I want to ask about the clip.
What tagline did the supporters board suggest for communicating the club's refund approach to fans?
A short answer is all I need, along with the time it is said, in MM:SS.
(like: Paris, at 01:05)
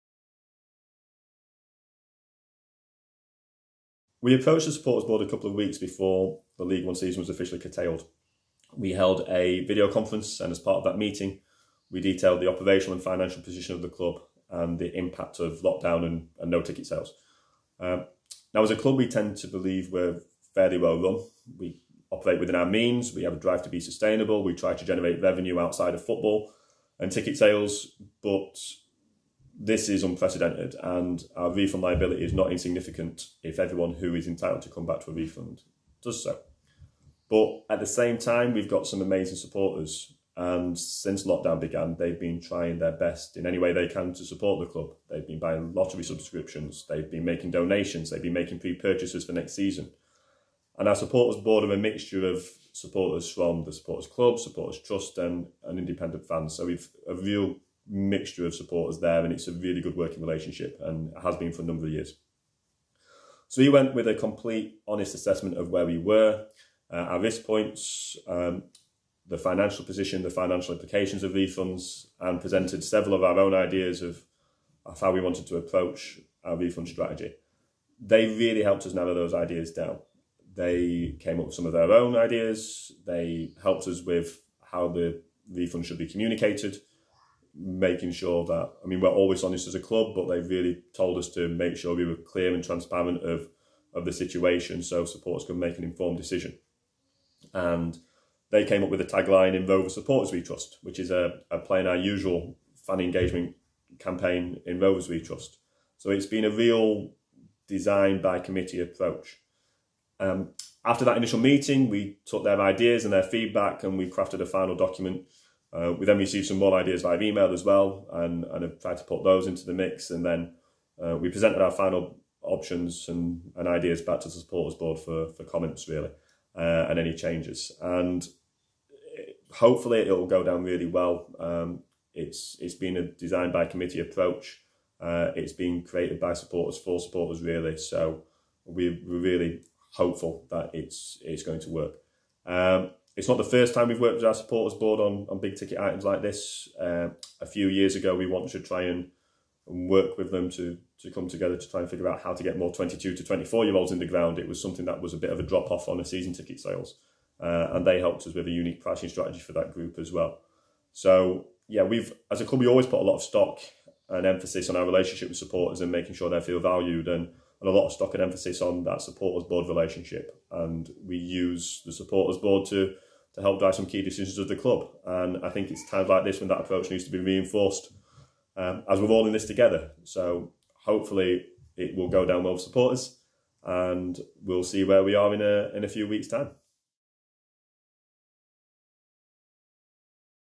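In Rover Supporters We Trust, at 01:39.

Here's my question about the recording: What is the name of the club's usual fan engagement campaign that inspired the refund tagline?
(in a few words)
In Rovers We Trust.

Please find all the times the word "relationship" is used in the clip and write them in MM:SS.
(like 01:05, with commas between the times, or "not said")
01:00, 02:44, 02:49.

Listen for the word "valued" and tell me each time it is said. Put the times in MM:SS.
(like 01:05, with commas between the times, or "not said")
02:46.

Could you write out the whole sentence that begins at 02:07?
And hopefully it will go down really well.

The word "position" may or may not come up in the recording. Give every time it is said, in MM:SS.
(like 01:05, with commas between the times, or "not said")
00:13, 01:09.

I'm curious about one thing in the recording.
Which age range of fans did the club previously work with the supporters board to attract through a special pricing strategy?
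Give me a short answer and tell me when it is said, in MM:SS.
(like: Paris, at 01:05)
22 to 24, at 02:32.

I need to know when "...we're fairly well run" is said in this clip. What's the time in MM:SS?
00:19.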